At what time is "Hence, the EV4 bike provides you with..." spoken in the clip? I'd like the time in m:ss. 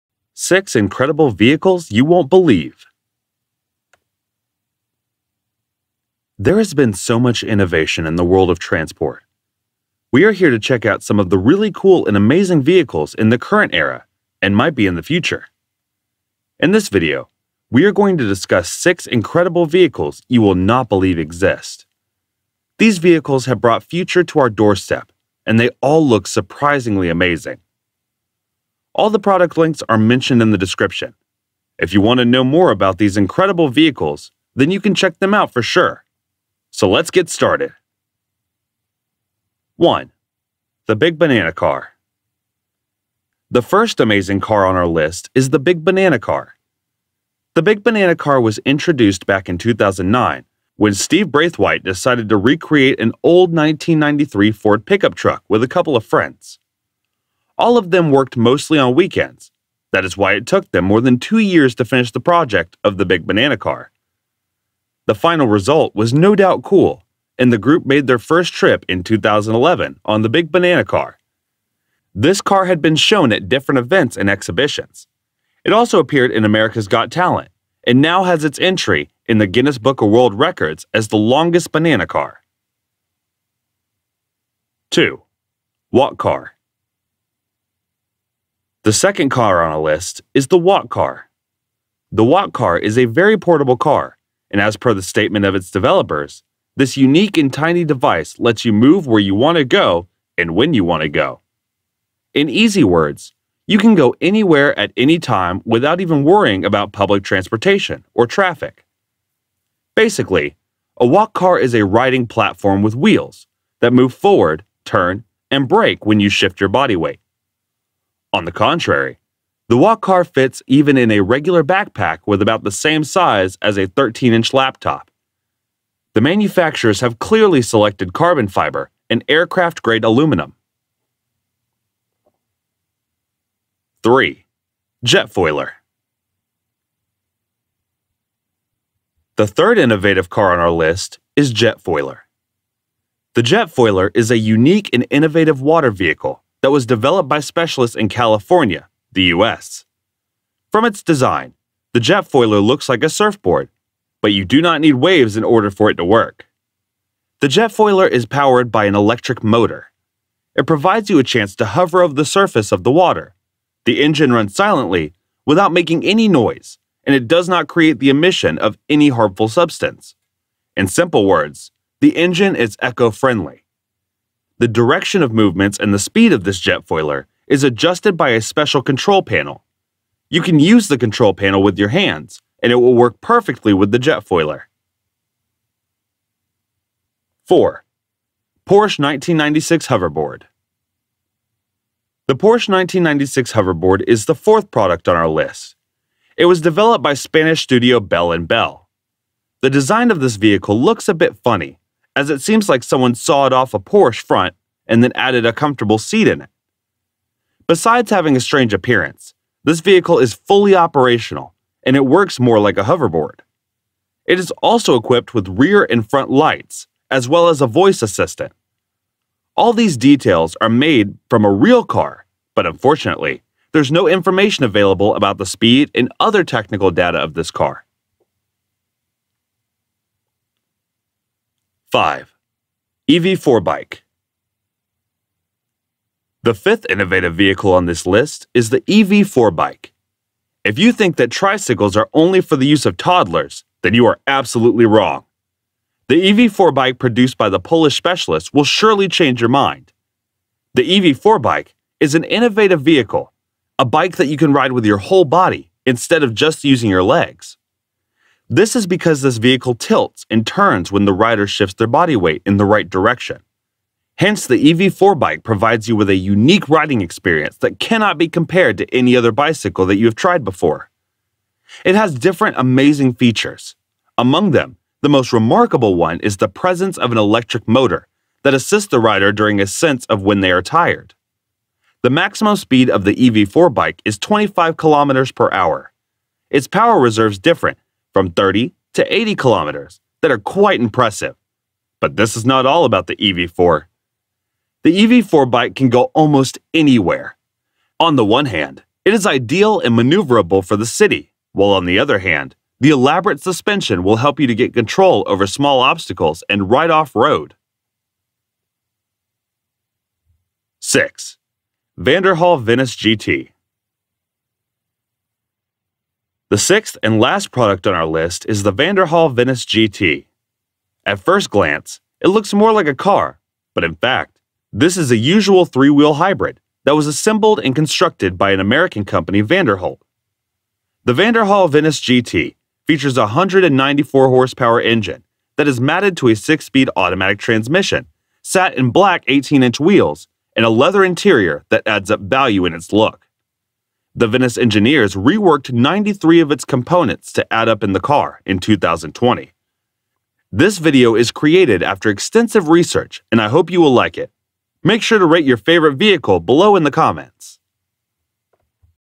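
4:24.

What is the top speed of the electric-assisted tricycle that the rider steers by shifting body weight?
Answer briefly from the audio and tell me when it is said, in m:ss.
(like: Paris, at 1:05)
25 km/h, at 4:44.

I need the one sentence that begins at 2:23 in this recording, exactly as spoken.
The Jetfoiler is a unique and innovative water vehicle that was developed by specialists in California, the US.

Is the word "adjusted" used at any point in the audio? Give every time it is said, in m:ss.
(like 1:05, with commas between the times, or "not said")
2:57.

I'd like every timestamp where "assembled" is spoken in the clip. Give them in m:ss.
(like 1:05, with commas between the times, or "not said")
5:27.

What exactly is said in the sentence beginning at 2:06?
The manufacturers have clearly selected carbon fiber and aircraft grade aluminum.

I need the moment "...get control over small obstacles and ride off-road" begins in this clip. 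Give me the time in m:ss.
5:04.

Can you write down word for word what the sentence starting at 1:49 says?
Basically, a walk car is a riding platform with wheels that move forward, turn, and brake when you shift your body weight.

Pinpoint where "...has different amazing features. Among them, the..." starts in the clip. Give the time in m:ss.
4:31.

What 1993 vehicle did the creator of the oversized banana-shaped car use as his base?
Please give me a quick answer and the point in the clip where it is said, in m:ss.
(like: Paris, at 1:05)
Ford pickup truck, at 0:54.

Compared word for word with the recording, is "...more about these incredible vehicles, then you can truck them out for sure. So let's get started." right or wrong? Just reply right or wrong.
wrong.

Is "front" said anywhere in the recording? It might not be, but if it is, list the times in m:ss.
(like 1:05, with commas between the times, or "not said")
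3:24, 3:36.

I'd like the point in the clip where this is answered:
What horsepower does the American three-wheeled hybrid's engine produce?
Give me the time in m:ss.
5:33.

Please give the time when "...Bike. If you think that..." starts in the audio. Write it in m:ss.
3:59.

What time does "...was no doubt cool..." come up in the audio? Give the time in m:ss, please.
1:05.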